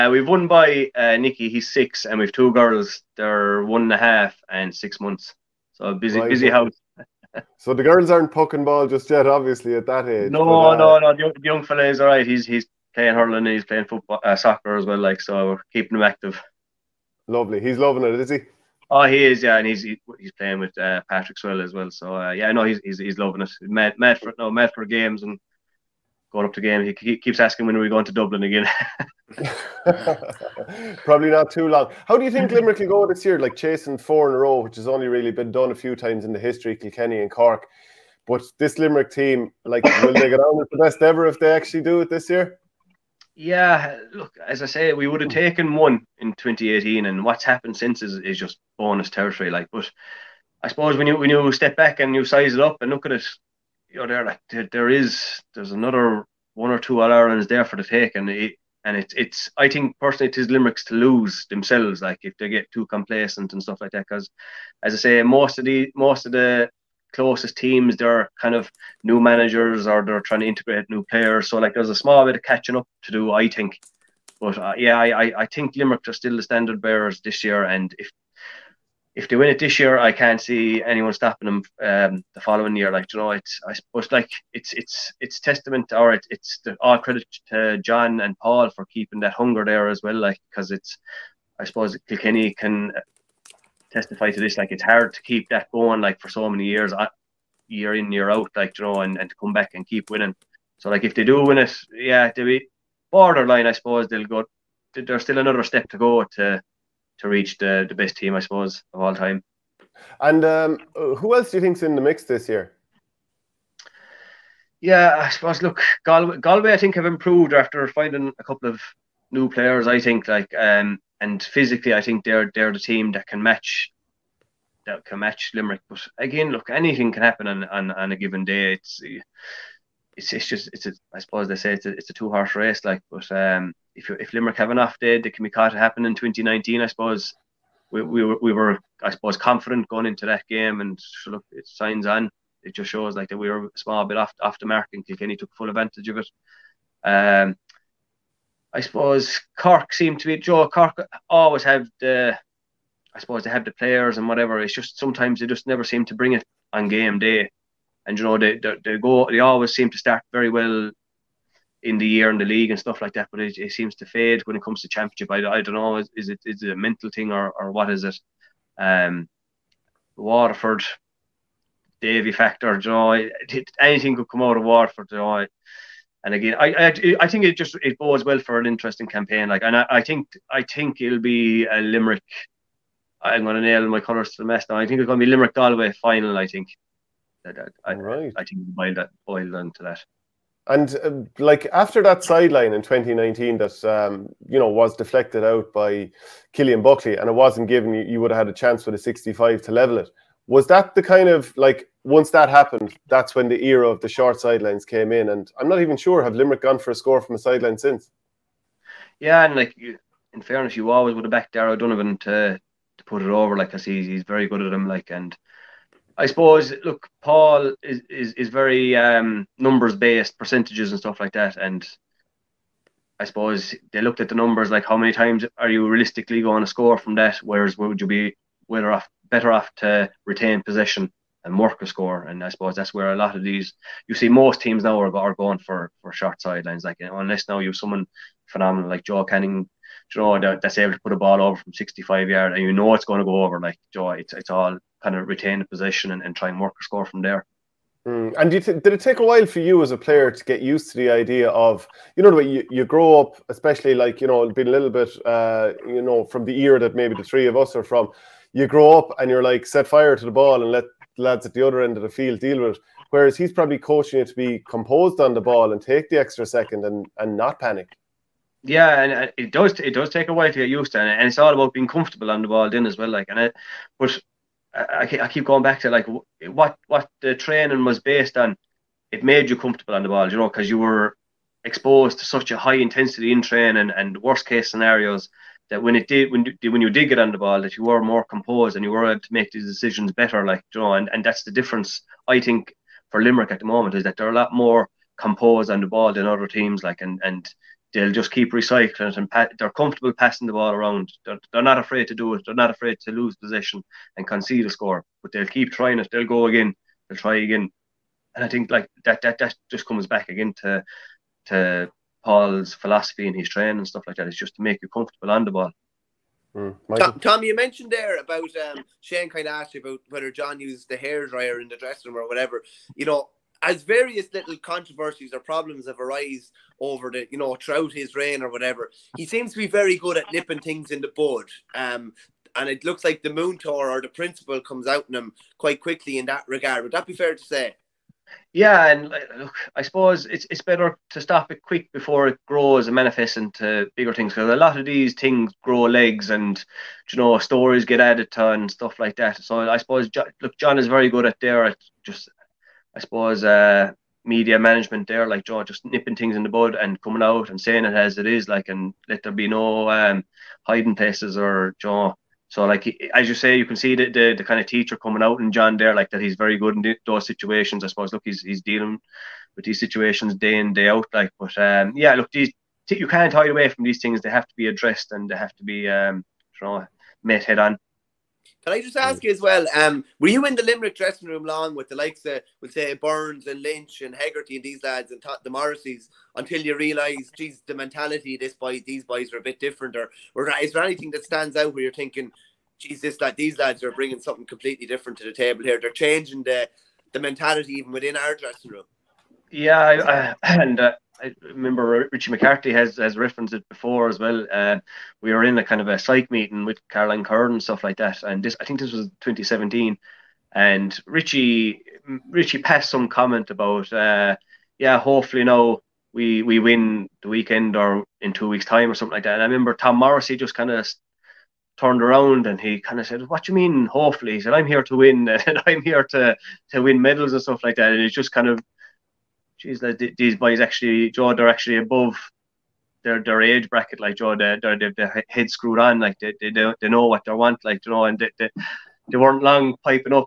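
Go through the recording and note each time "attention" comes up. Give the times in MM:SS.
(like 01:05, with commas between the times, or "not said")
not said.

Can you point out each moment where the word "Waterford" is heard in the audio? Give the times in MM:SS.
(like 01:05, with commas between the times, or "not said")
02:50, 02:54.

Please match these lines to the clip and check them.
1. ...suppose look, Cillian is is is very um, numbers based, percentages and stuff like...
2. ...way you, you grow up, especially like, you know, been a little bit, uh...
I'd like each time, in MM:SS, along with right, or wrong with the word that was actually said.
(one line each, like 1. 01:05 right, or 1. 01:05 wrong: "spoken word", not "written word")
1. 03:36 wrong: "Paul", not "Cillian"
2. 04:12 right.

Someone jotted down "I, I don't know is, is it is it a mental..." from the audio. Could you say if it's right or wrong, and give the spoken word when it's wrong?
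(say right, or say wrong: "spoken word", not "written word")
right.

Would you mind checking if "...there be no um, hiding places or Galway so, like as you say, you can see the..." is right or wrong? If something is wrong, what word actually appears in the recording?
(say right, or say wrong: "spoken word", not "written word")
wrong: "John", not "Galway".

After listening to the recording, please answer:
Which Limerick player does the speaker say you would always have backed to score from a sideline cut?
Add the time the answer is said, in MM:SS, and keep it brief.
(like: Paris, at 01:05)
Darragh Donovan, at 03:31.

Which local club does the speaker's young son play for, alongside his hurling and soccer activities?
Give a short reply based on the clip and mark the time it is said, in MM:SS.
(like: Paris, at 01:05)
Patrickswell, at 00:21.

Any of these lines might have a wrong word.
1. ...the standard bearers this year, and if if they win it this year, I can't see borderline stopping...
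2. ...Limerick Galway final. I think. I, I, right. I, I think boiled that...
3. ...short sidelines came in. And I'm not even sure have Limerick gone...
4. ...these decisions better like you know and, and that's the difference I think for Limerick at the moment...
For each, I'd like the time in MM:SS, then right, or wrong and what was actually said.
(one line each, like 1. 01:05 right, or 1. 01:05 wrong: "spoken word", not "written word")
1. 01:16 wrong: "anyone", not "borderline"
2. 03:05 right
3. 03:24 right
4. 04:49 right.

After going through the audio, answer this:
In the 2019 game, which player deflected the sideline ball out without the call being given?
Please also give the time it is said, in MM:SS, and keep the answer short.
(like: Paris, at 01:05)
Cillian Buckley, at 03:16.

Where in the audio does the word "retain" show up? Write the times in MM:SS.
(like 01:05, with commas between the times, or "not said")
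03:50, 04:05.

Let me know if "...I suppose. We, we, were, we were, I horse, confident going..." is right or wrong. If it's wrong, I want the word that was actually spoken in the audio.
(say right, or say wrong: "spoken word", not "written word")
wrong: "suppose", not "horse".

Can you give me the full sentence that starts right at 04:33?
Like, and it, but I, I keep going back to like what what the training was based on.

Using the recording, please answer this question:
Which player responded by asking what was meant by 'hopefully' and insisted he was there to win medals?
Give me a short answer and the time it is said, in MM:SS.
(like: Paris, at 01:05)
Tom Morrissey, at 06:59.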